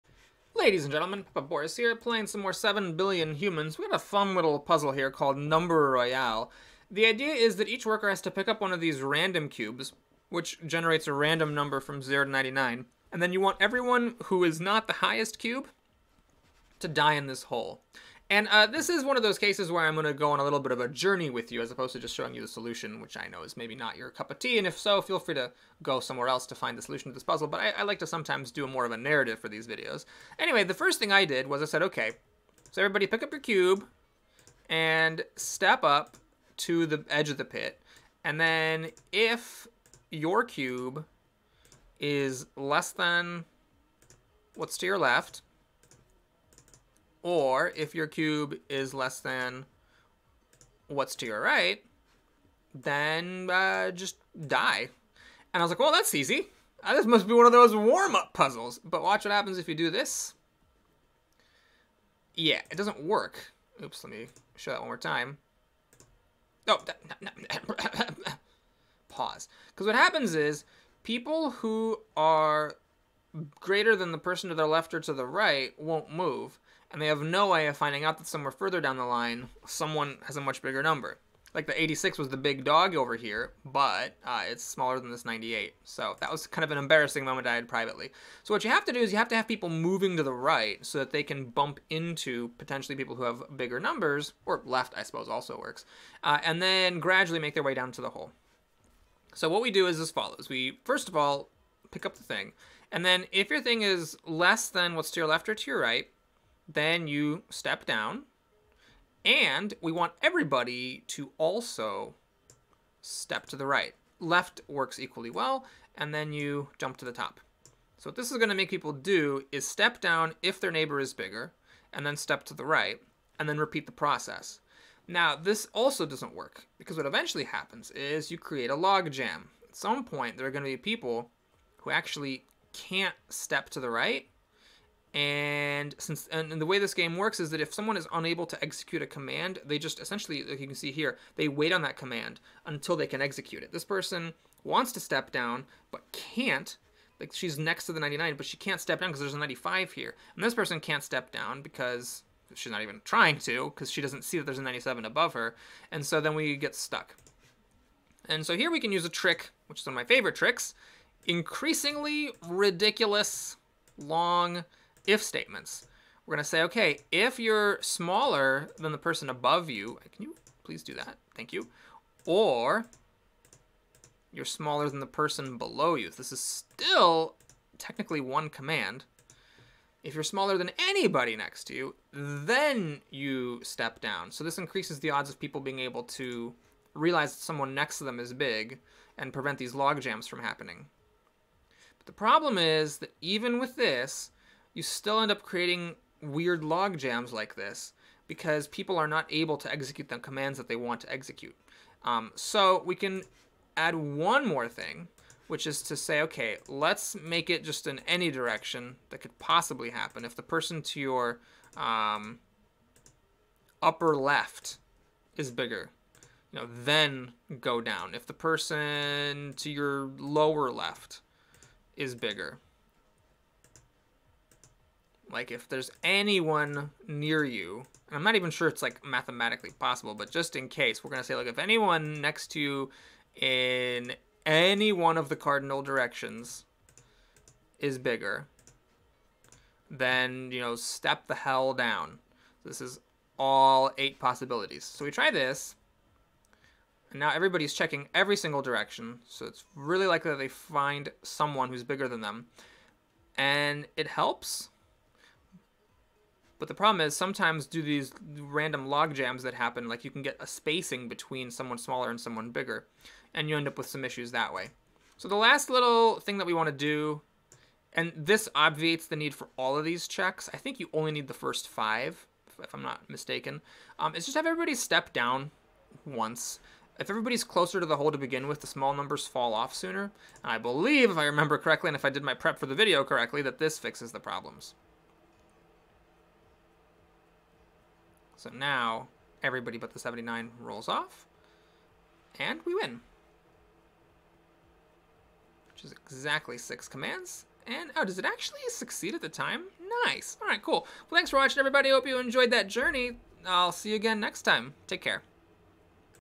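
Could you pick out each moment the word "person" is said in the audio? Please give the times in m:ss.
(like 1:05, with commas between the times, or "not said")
1:14, 2:23, 2:30, 2:48, 2:55, 3:30, 3:38.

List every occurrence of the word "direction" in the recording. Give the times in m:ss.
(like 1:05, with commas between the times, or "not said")
3:28, 3:55, 4:08.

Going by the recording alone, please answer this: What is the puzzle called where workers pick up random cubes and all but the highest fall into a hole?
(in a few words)
Number Royale.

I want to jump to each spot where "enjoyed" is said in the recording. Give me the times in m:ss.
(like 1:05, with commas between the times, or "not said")
5:02.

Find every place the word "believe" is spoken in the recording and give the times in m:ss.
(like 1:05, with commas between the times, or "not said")
4:40.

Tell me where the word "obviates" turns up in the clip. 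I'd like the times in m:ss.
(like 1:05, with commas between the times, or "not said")
4:28.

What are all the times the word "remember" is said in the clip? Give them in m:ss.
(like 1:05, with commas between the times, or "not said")
4:41.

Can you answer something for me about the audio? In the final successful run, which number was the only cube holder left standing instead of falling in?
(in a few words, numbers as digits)
79.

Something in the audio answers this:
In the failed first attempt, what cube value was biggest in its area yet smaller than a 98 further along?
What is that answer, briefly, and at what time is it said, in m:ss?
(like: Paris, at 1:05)
86, at 1:21.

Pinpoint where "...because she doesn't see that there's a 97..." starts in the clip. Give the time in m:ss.
2:33.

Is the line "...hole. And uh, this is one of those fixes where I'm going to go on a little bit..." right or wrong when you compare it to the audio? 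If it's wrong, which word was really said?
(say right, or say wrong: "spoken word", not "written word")
wrong: "cases", not "fixes".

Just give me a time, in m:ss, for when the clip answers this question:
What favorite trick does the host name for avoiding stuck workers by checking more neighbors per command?
2:43.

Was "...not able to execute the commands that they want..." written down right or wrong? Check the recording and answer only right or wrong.
right.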